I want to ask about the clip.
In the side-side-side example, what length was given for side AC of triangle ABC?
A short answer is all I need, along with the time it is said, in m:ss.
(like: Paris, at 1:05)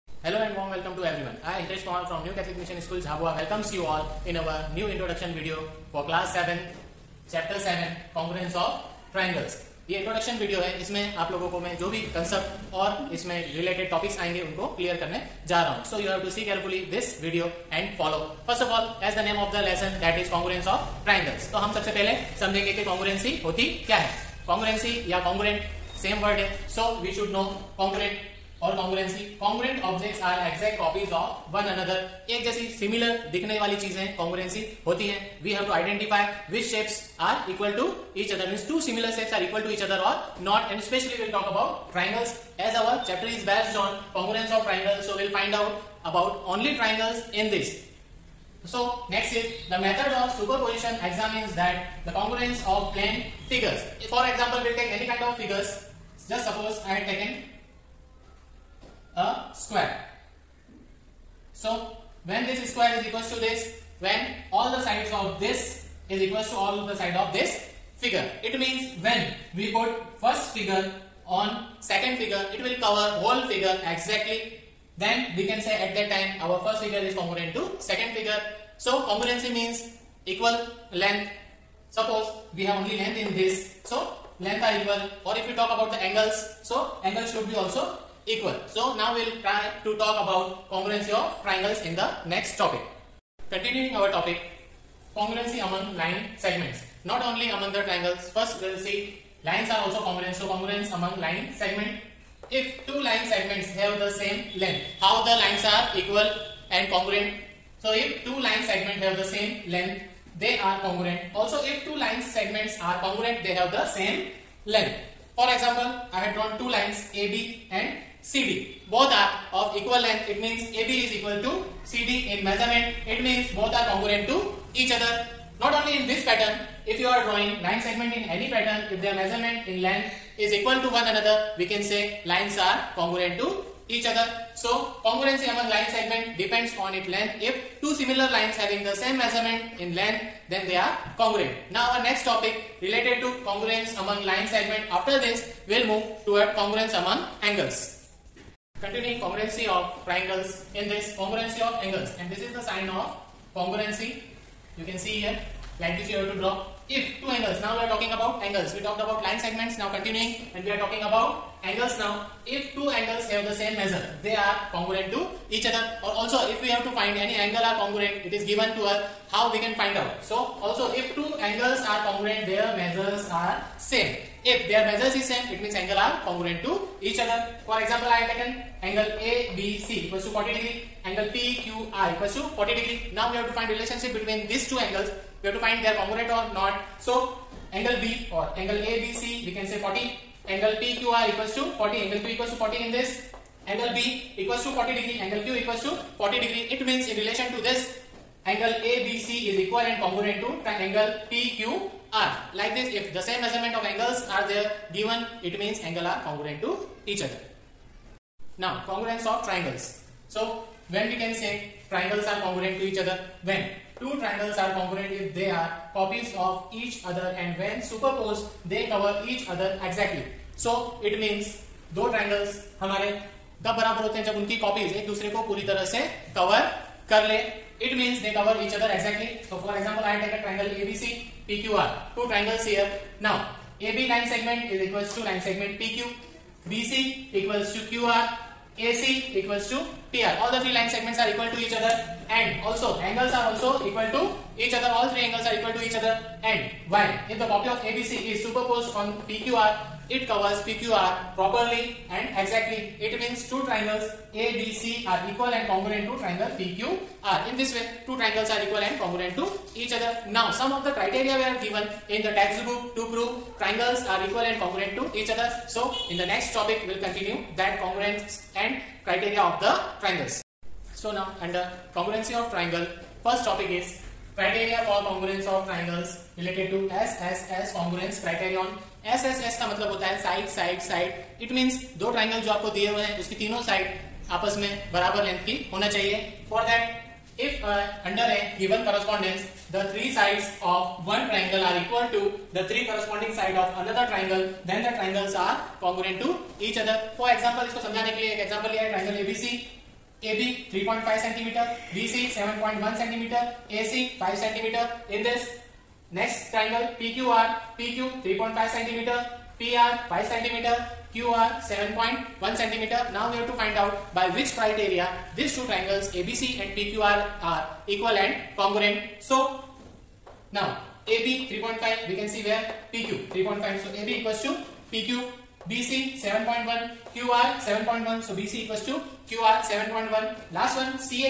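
5 cm, at 5:03.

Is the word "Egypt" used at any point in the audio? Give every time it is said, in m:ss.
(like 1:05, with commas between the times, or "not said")
not said.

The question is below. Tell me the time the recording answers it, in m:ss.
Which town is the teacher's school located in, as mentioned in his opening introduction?
0:02.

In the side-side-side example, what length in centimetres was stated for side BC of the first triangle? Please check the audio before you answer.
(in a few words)
7.1 cm.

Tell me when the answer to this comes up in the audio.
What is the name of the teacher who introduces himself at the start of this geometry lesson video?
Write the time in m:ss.
0:01.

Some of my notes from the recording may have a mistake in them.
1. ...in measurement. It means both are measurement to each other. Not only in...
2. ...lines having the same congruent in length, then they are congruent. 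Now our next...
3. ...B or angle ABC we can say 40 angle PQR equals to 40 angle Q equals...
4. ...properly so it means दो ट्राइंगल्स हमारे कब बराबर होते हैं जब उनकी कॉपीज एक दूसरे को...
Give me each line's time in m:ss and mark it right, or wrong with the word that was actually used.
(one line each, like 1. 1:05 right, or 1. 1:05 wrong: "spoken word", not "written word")
1. 2:02 wrong: "congruent", not "measurement"
2. 2:18 wrong: "measurement", not "congruent"
3. 3:08 right
4. 3:39 wrong: "exactly", not "properly".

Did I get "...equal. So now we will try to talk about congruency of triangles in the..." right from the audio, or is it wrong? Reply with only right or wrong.
right.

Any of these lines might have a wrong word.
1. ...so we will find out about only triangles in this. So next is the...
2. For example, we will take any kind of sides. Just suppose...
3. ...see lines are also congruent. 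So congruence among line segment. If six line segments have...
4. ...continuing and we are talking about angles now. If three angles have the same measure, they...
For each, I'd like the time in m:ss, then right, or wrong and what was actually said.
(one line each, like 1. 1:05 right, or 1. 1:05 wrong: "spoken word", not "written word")
1. 0:45 right
2. 0:54 wrong: "figures", not "sides"
3. 1:38 wrong: "two", not "six"
4. 2:39 wrong: "two", not "three".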